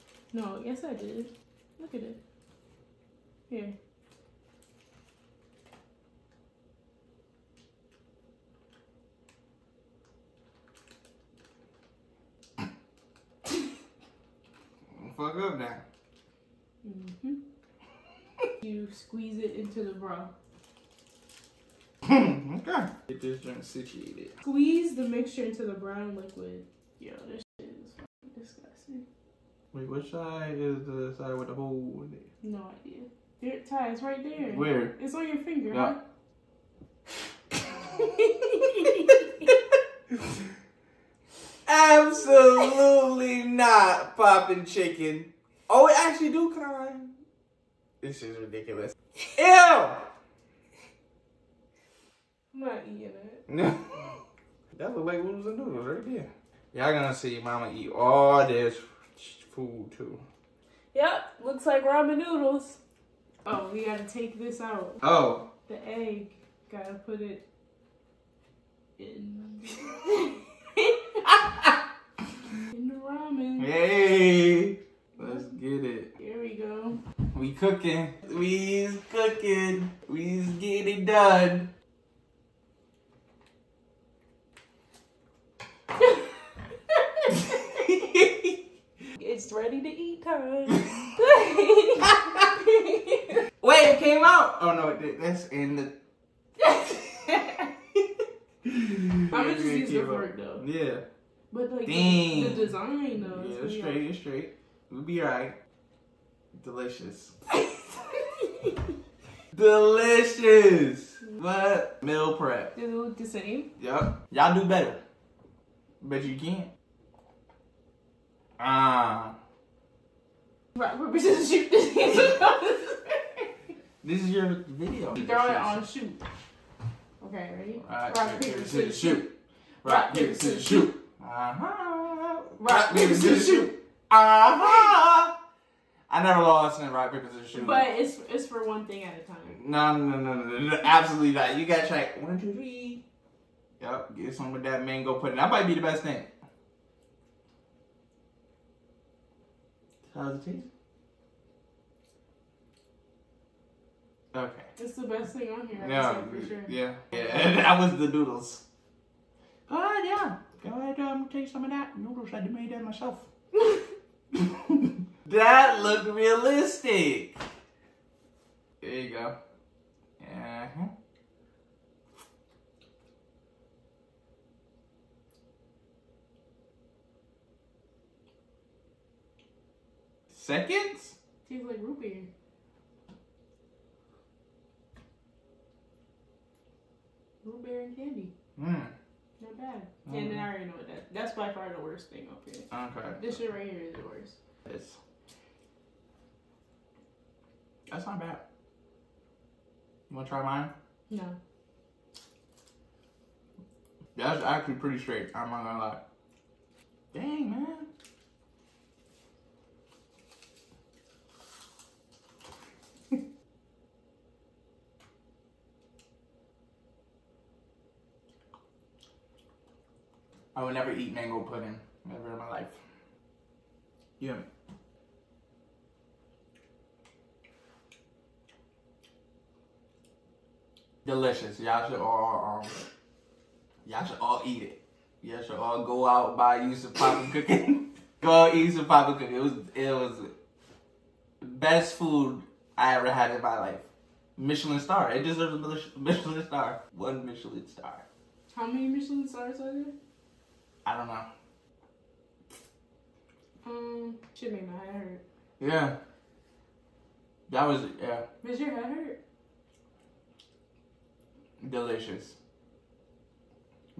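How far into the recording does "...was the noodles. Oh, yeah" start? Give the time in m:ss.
2:37.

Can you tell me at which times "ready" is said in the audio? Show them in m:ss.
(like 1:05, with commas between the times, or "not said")
1:29, 2:07.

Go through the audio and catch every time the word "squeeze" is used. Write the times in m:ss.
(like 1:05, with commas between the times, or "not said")
0:18, 0:24.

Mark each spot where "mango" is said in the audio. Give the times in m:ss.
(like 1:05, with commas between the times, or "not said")
2:24, 3:41.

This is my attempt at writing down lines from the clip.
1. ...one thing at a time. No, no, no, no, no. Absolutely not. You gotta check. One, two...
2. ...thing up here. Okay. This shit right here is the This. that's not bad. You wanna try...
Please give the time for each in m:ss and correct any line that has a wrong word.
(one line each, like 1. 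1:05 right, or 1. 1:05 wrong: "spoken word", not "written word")
1. 2:18 right
2. 3:12 right.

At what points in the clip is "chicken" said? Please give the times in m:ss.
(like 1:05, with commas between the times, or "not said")
0:44.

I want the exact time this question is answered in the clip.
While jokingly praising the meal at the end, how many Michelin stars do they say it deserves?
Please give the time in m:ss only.
4:06.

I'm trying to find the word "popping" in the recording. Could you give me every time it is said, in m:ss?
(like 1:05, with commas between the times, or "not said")
0:44.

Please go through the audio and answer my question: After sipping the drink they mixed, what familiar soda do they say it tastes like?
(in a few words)
root beer.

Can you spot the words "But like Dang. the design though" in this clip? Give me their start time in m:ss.
1:41.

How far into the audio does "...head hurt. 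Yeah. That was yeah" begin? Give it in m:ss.
4:14.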